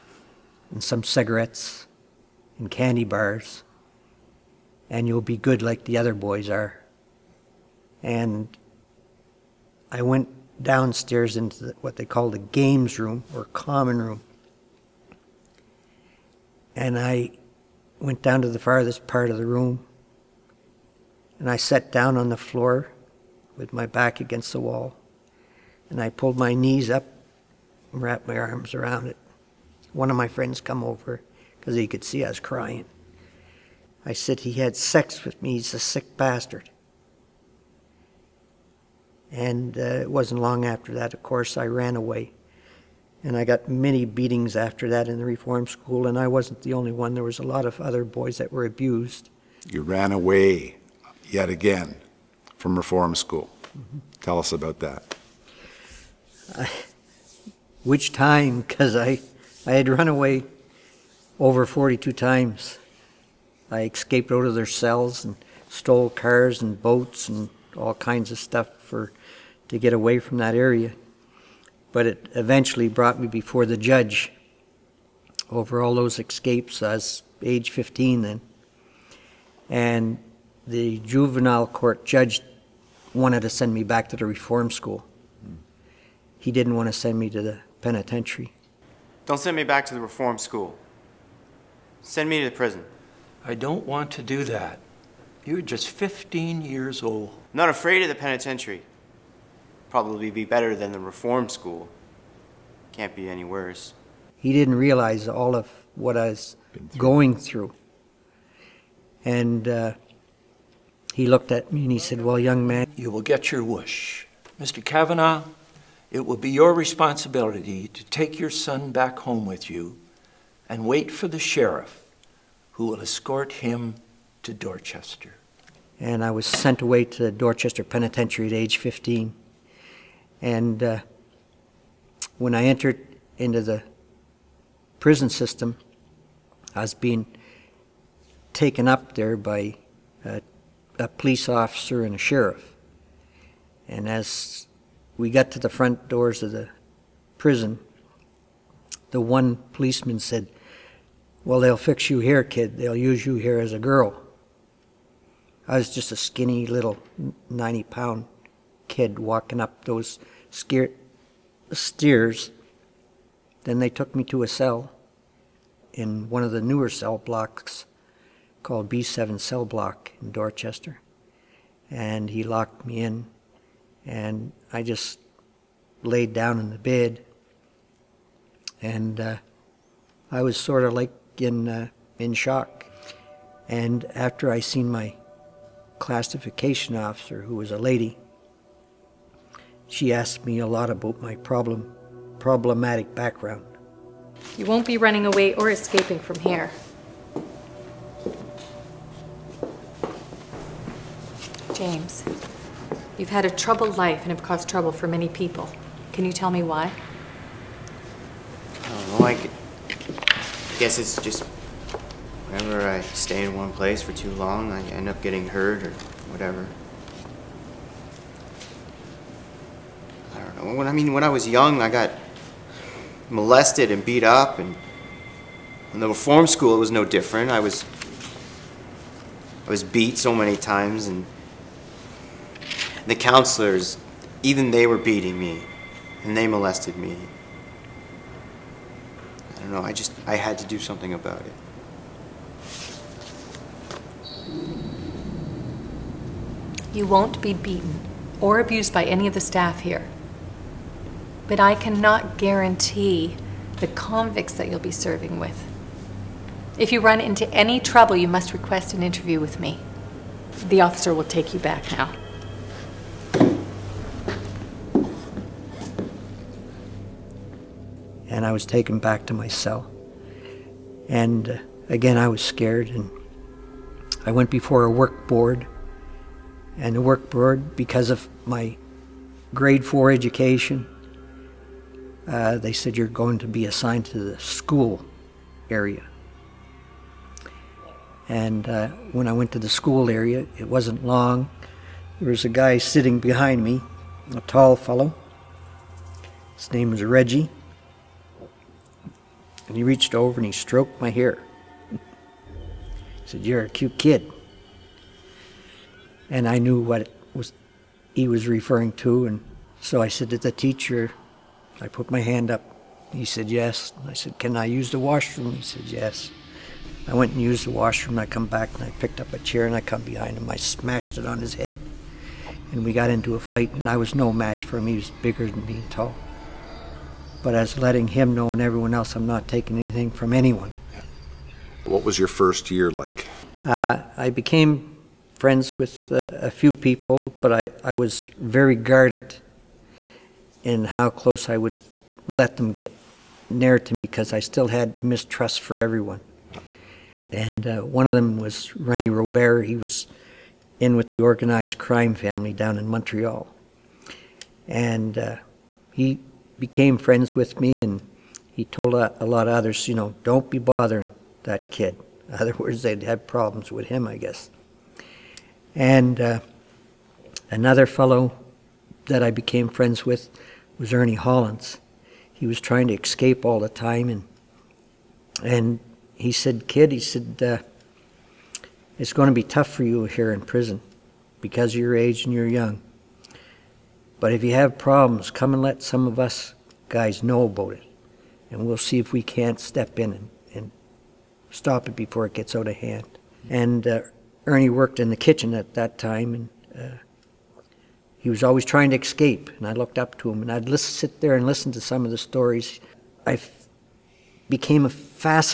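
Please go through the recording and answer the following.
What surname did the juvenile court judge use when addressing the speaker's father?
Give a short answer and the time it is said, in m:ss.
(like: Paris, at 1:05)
Cavanagh, at 1:54.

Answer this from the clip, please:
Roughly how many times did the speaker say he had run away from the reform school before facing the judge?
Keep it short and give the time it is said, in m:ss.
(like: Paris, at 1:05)
42, at 1:01.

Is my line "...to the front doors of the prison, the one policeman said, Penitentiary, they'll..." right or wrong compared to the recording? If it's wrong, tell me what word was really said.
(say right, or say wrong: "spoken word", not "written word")
wrong: "Well", not "Penitentiary".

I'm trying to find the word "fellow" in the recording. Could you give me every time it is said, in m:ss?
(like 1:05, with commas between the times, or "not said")
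4:54, 6:07.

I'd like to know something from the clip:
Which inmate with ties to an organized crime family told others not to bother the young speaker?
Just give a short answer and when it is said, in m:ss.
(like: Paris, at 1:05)
Rennie Robert, at 5:48.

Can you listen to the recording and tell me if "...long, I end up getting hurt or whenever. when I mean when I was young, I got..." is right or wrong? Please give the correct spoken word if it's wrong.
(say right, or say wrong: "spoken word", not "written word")
wrong: "whatever", not "whenever".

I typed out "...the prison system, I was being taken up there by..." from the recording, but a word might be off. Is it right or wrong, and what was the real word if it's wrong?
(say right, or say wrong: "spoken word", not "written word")
right.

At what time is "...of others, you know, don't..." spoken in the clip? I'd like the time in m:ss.
5:59.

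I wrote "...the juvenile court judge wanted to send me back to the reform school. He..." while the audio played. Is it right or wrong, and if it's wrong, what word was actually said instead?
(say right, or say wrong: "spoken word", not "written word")
right.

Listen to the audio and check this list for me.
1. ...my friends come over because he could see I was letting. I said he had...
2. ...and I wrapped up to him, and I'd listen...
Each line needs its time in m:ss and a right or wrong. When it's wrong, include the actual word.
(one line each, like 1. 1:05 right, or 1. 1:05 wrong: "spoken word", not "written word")
1. 0:30 wrong: "crying", not "letting"
2. 6:39 wrong: "looked", not "wrapped".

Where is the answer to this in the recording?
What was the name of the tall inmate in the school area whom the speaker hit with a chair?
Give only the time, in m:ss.
4:57.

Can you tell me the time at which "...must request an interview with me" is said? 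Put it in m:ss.
4:18.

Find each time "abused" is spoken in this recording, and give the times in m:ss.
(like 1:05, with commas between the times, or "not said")
0:48, 4:08.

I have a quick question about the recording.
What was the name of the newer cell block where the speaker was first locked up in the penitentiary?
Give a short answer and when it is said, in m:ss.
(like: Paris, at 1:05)
B7, at 2:48.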